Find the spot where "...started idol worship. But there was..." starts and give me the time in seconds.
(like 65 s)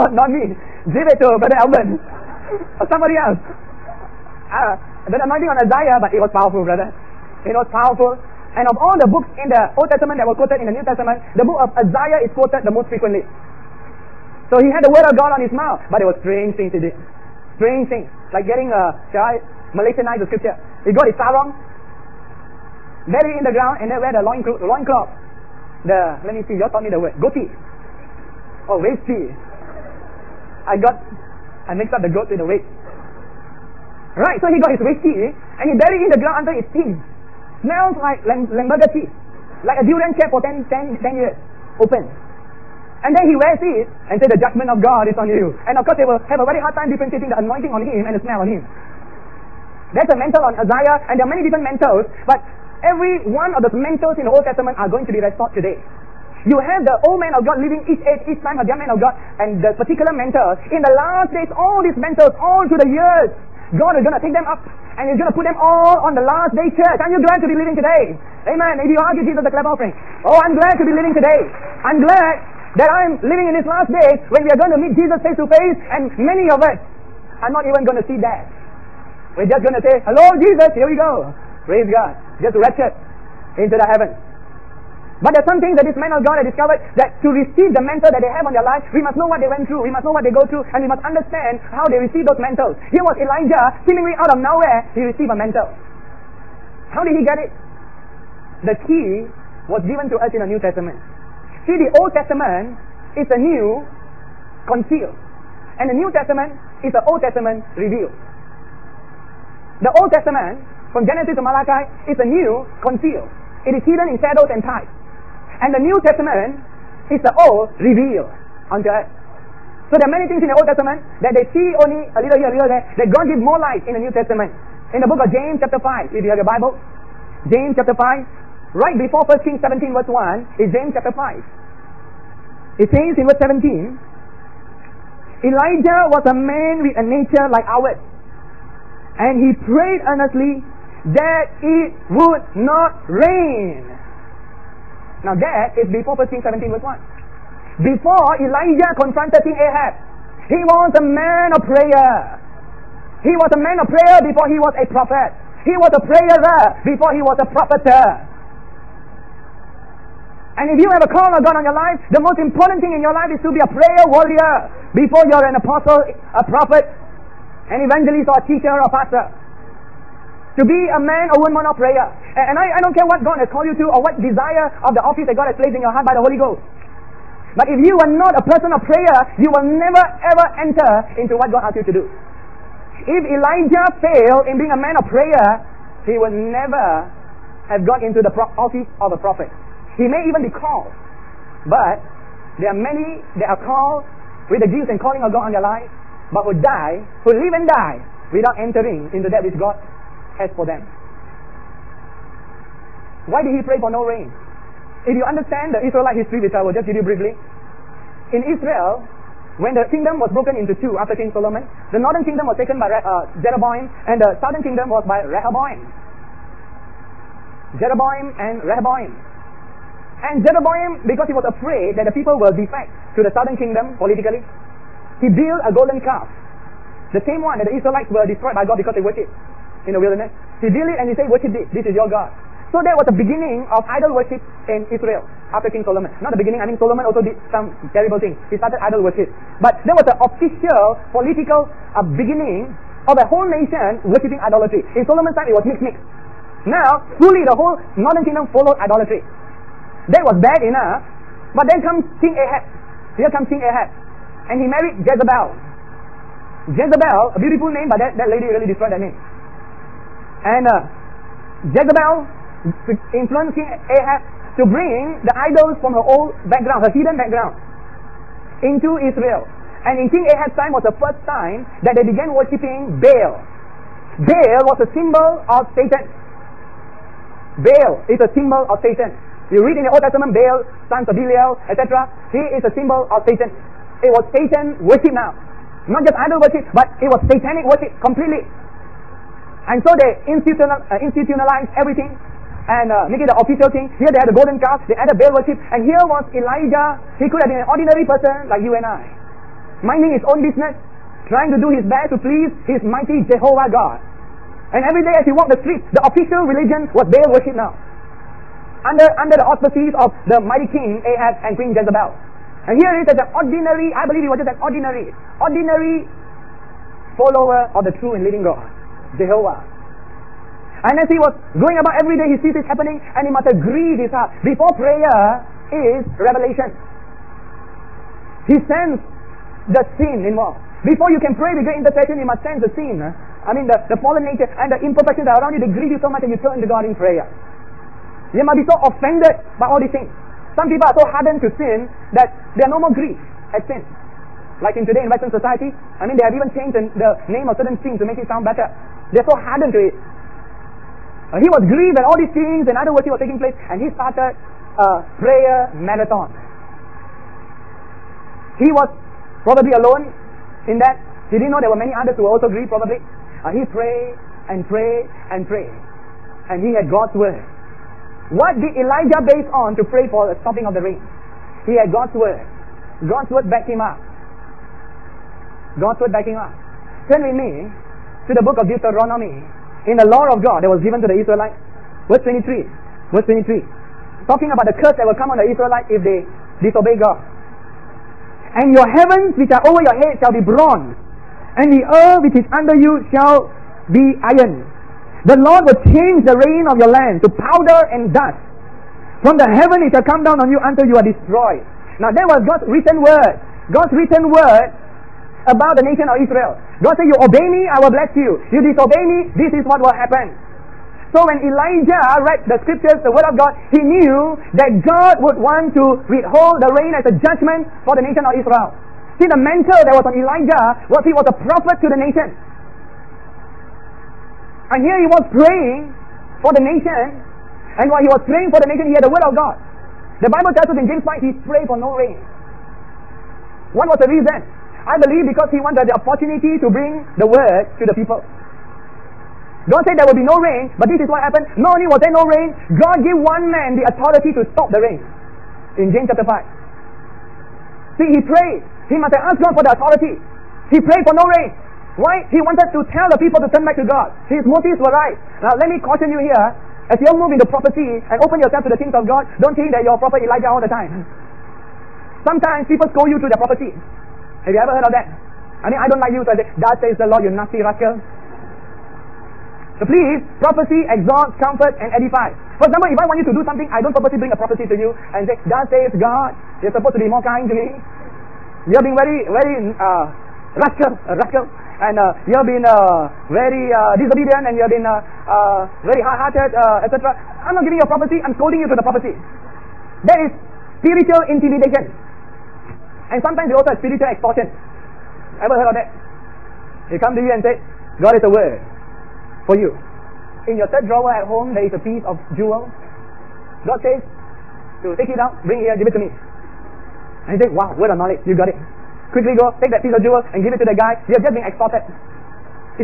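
238 s.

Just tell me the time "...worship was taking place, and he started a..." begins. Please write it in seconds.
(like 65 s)
352 s.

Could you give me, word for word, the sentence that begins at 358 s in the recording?
He was probably alone in that.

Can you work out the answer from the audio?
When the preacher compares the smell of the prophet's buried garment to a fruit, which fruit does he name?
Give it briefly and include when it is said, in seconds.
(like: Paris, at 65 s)
durian, at 39 s.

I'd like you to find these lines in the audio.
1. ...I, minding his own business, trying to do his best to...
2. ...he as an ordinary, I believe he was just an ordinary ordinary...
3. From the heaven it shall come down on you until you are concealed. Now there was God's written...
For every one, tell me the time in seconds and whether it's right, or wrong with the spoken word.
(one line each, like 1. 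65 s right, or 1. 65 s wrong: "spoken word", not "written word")
1. 298 s right
2. 312 s right
3. 399 s wrong: "destroyed", not "concealed".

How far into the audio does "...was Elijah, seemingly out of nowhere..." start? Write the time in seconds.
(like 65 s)
93 s.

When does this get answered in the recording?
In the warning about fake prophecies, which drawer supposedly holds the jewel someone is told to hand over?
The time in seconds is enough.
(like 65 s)
500 s.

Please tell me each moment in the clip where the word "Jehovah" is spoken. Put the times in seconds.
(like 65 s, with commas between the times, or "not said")
303 s, 319 s.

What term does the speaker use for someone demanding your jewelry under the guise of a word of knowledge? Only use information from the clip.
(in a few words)
spiritual extortion.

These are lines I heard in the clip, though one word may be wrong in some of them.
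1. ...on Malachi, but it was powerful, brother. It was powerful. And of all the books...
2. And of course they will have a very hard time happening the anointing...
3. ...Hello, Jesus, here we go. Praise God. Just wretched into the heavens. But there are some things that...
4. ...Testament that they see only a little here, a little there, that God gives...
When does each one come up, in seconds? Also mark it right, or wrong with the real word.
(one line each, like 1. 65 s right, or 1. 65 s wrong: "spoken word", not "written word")
1. 5 s wrong: "Isaiah", not "Malachi"
2. 45 s wrong: "differentiating", not "happening"
3. 80 s right
4. 120 s right.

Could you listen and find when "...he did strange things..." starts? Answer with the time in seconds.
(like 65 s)
16 s.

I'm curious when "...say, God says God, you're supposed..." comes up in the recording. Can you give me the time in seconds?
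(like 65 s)
475 s.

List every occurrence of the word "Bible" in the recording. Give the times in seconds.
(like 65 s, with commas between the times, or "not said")
126 s, 430 s.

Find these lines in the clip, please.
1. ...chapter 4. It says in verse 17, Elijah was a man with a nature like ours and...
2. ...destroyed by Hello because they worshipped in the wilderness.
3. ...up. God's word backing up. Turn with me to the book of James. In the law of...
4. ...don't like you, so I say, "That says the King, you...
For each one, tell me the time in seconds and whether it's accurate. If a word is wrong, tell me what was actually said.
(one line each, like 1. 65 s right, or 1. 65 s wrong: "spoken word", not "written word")
1. 130 s wrong: "5", not "4"
2. 228 s wrong: "God", not "Hello"
3. 373 s wrong: "Deuteronomy", not "James"
4. 465 s wrong: "Lord", not "King".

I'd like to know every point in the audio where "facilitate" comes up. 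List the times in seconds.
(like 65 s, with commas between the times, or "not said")
not said.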